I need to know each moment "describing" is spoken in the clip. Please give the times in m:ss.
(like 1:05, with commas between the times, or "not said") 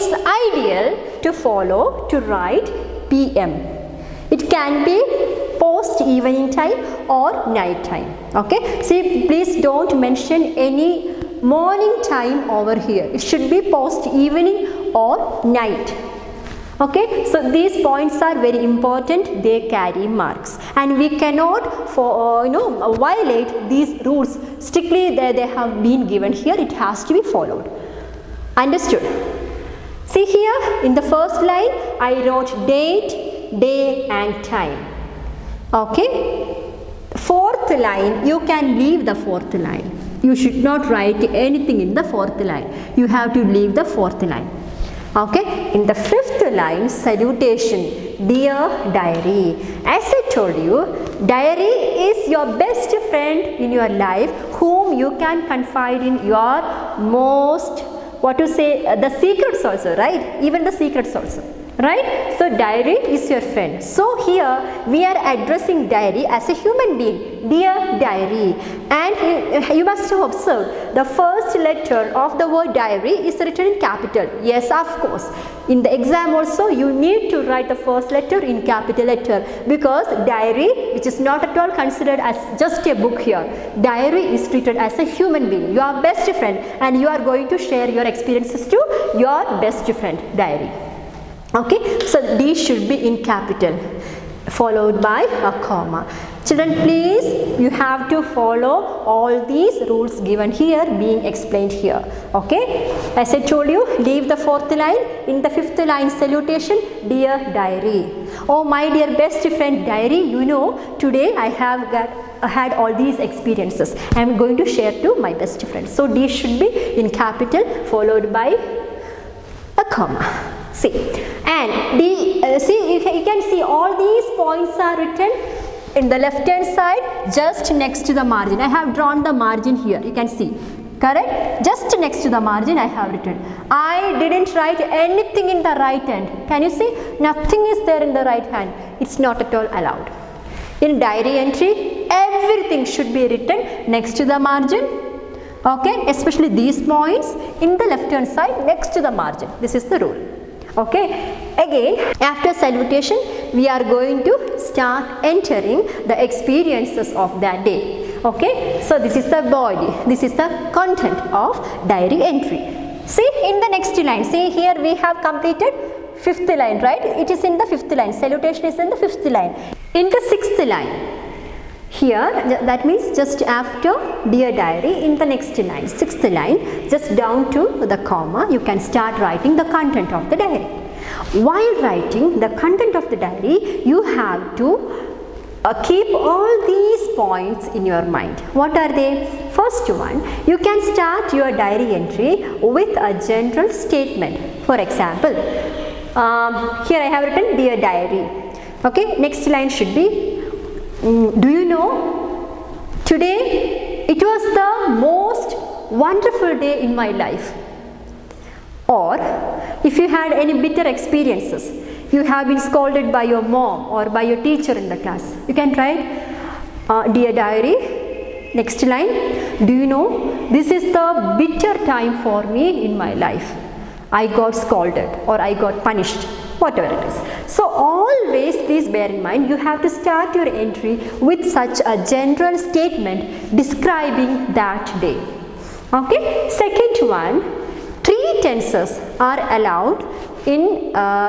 3:53.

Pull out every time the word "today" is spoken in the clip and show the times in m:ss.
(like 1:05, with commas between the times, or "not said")
1:50, 3:23.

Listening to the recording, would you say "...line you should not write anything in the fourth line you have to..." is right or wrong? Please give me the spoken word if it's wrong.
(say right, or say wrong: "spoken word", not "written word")
right.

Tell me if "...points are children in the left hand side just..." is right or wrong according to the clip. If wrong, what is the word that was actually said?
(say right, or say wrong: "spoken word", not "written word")
wrong: "written", not "children".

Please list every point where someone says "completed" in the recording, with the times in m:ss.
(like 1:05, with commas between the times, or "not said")
2:45.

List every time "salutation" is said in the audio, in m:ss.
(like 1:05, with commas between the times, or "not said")
0:47, 1:46, 2:32, 2:48.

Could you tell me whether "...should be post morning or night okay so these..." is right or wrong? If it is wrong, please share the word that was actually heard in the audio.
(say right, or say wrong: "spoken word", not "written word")
wrong: "evening", not "morning".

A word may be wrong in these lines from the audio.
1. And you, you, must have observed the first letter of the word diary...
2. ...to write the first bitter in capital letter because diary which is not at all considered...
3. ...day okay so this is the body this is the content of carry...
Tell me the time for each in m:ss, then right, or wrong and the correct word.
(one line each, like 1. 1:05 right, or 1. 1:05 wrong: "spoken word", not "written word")
1. 1:08 right
2. 1:17 wrong: "letter", not "bitter"
3. 2:37 wrong: "diary", not "carry".